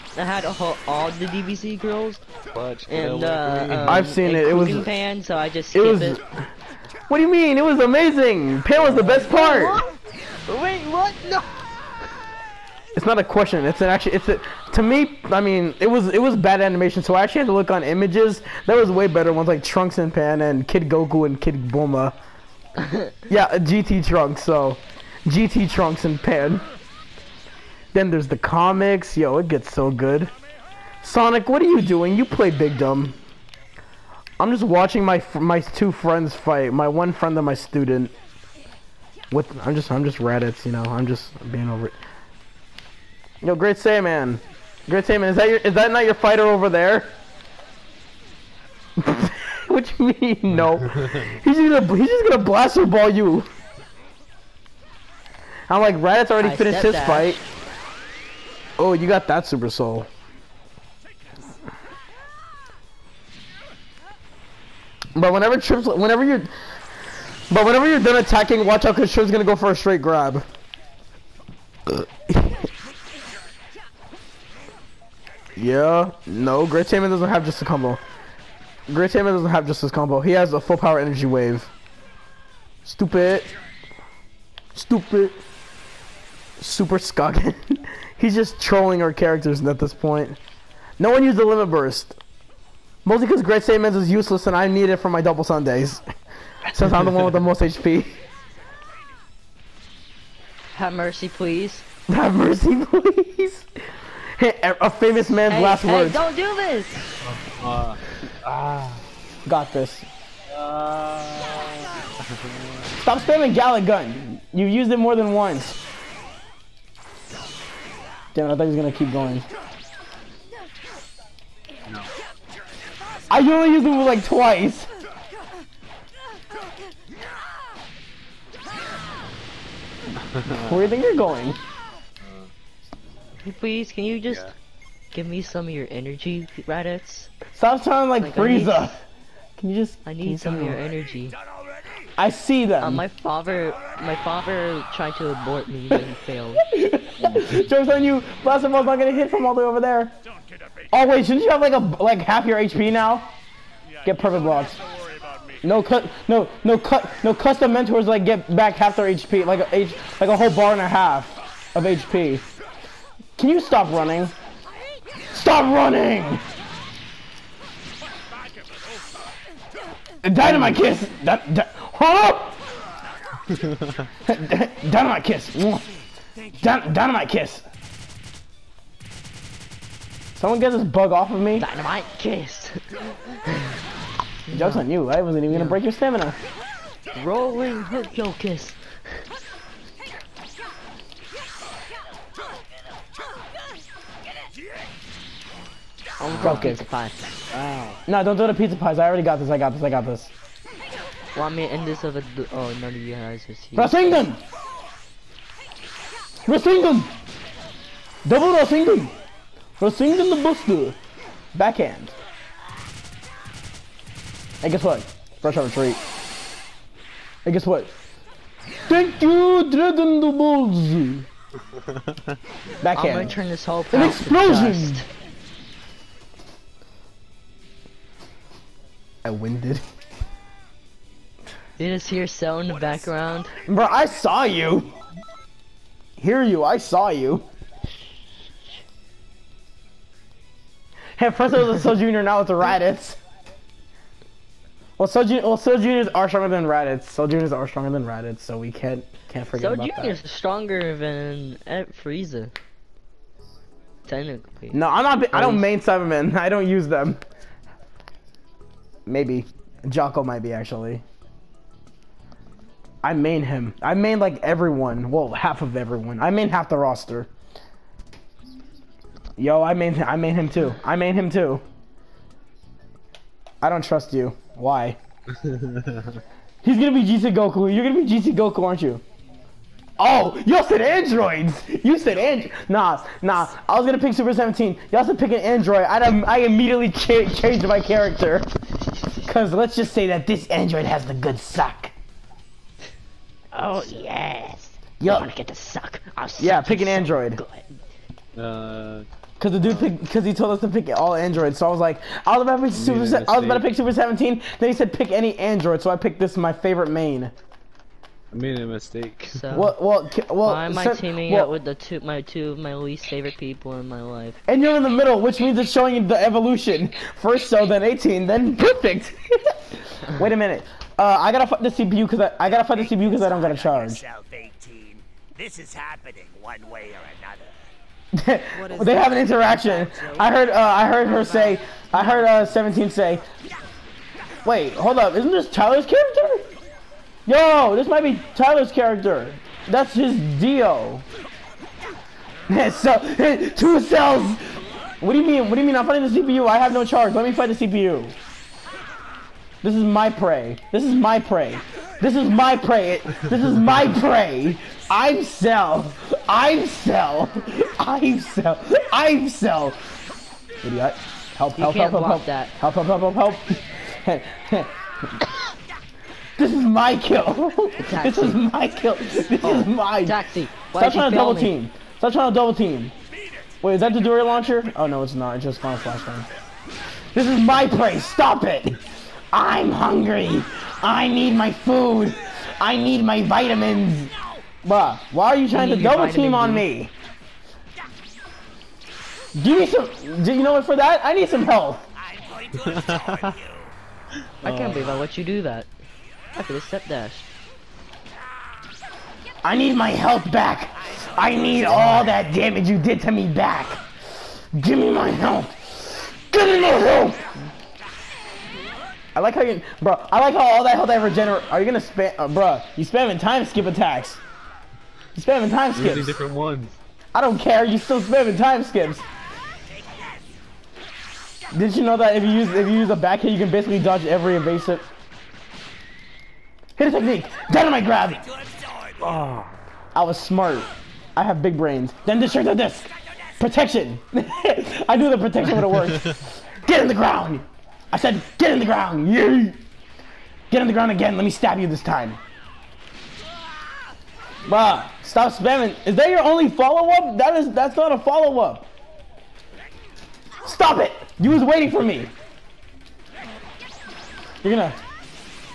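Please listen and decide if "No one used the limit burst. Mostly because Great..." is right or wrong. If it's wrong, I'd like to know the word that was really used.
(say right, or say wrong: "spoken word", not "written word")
right.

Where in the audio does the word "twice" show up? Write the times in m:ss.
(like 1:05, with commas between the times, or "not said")
2:04.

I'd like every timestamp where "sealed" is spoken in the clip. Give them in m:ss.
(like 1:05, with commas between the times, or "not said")
not said.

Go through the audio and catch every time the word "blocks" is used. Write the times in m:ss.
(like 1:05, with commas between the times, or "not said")
2:34, 6:01.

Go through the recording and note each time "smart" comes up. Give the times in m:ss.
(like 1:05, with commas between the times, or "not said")
7:10.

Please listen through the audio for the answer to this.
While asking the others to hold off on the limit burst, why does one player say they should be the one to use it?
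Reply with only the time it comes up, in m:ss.
1:36.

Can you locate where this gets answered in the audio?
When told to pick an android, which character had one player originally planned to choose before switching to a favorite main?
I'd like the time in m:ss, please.
4:43.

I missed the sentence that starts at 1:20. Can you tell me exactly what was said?
He has a full power energy wave.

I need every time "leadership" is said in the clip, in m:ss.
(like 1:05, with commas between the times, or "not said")
not said.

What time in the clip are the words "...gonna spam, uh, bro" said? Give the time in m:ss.
6:51.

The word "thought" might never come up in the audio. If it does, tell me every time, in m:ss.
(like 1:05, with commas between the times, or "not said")
1:58.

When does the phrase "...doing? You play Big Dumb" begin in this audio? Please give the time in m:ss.
0:31.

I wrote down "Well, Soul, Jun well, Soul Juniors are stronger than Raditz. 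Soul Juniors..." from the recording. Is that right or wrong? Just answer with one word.
right.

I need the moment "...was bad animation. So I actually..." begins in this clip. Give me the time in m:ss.
0:16.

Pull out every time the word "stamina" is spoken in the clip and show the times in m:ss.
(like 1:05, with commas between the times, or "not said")
3:05.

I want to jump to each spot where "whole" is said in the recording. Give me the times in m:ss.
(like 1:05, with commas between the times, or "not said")
2:40, 3:43.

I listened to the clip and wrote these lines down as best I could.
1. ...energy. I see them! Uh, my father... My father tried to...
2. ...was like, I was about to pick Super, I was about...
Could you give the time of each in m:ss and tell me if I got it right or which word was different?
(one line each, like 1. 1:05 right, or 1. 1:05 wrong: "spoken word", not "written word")
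1. 2:20 right
2. 5:01 right.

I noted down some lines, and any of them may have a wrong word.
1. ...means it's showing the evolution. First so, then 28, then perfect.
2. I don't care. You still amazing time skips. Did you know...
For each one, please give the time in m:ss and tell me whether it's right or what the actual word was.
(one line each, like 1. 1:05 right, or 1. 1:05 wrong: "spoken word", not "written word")
1. 5:15 wrong: "18", not "28"
2. 6:57 wrong: "spamming", not "amazing".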